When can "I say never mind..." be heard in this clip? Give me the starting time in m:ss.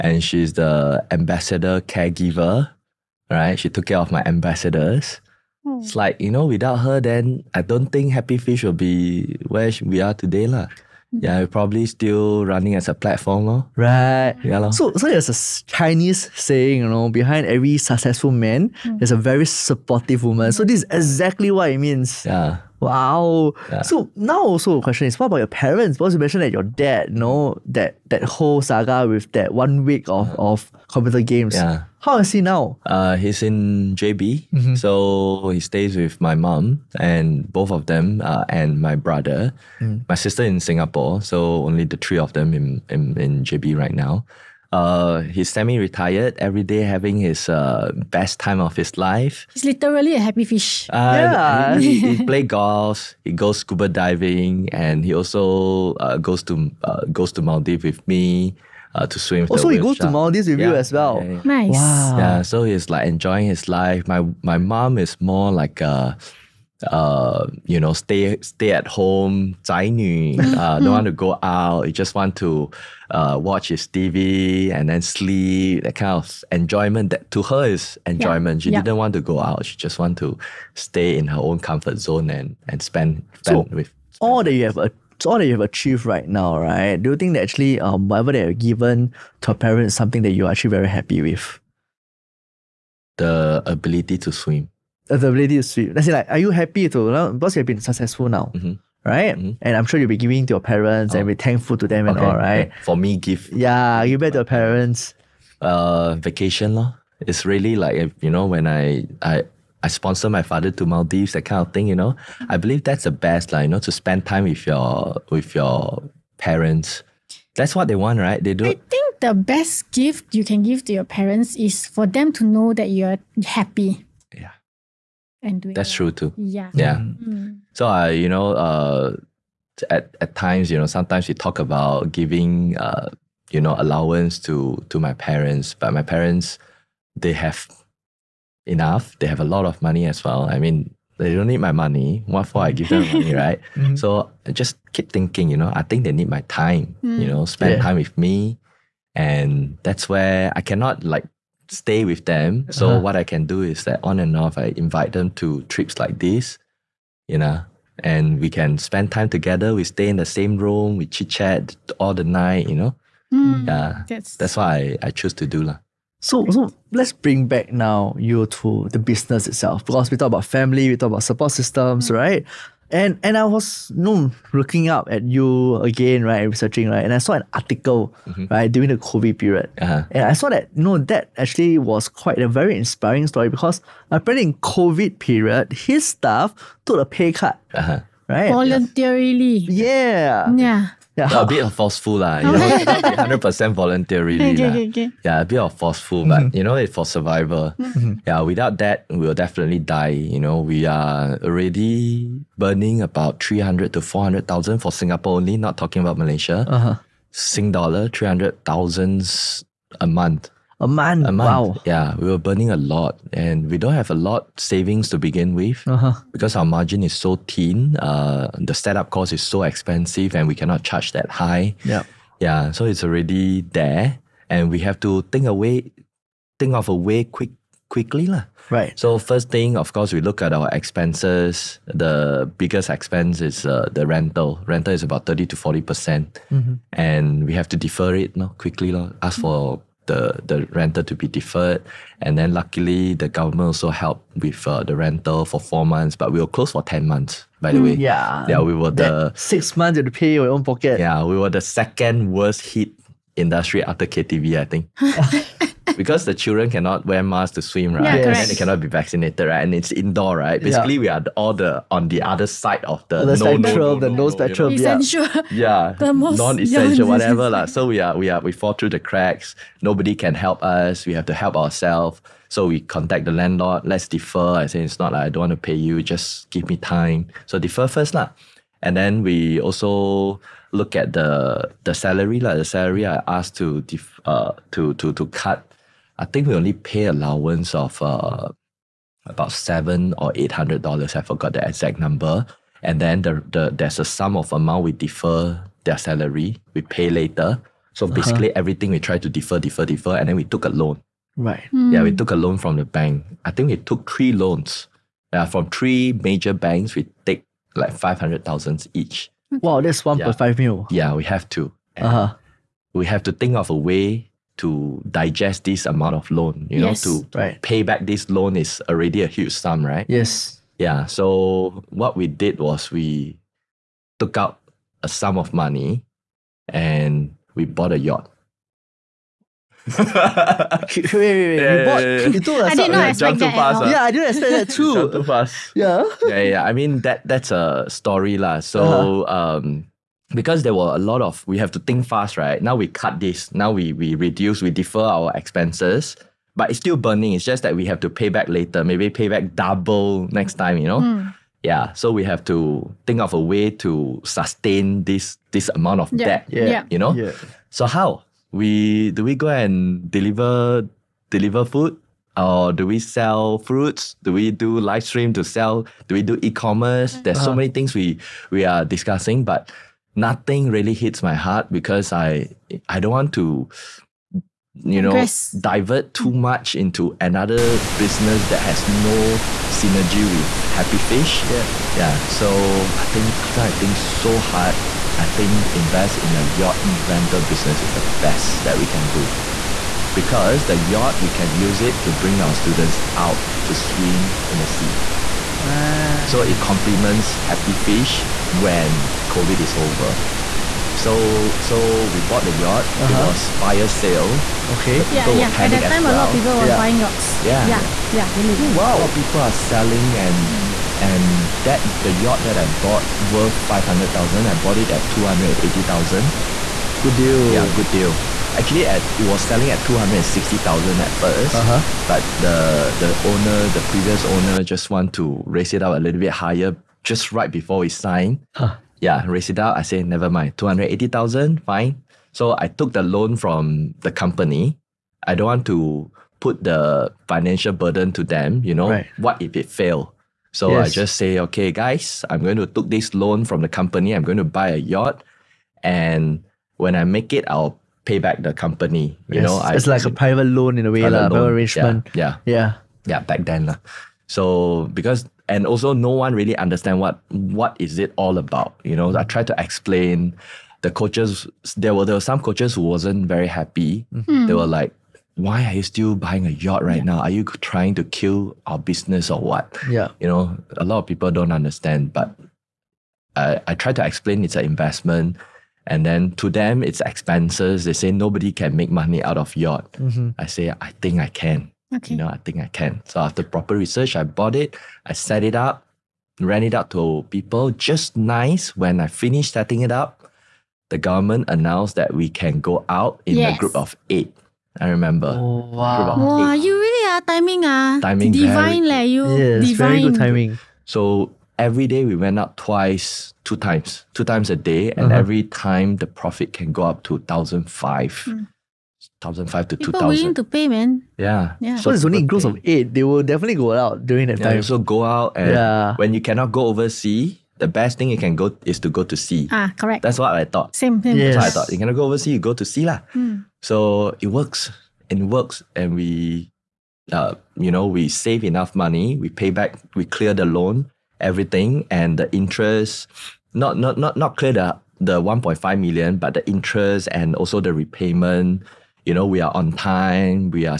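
7:09.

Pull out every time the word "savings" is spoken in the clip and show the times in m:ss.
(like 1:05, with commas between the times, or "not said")
3:34.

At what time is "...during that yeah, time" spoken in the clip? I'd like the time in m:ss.
8:34.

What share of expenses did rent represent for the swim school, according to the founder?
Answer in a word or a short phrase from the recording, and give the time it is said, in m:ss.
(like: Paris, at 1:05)
30 to 40 percent, at 3:55.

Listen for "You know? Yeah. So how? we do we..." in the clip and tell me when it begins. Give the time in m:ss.
5:56.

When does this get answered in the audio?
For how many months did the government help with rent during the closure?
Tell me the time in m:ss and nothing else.
4:05.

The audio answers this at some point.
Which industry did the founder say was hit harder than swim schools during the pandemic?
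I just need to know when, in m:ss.
4:14.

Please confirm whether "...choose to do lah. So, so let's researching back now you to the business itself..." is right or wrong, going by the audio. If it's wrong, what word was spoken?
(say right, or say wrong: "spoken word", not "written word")
wrong: "bring", not "researching".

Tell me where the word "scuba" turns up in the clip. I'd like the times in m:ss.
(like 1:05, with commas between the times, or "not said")
0:53.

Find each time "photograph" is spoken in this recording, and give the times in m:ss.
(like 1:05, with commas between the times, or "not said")
not said.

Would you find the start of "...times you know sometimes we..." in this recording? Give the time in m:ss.
2:10.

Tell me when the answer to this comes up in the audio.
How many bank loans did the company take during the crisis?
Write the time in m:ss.
5:04.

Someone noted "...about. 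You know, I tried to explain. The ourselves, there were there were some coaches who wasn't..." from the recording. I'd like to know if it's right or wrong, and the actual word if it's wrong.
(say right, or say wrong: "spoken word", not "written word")
wrong: "coaches", not "ourselves".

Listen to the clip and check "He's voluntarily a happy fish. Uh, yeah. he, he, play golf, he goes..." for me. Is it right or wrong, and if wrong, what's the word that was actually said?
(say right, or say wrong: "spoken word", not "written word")
wrong: "literally", not "voluntarily".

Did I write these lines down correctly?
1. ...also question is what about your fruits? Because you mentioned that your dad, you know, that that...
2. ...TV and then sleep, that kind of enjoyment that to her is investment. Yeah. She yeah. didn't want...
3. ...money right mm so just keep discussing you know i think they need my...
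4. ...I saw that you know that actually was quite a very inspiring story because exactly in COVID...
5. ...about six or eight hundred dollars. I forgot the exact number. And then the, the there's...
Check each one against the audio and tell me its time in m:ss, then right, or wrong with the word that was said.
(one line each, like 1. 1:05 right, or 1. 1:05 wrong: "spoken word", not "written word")
1. 0:24 wrong: "parents", not "fruits"
2. 1:13 wrong: "enjoyment", not "investment"
3. 2:23 wrong: "thinking", not "discussing"
4. 3:00 wrong: "apparently", not "exactly"
5. 4:49 wrong: "seven", not "six".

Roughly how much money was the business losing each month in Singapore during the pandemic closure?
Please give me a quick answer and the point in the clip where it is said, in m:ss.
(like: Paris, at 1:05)
300,000 to 400,000, at 3:23.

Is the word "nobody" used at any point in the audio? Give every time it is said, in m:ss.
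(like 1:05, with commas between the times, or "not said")
4:29, 7:58.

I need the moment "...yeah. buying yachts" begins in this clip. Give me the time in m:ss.
6:46.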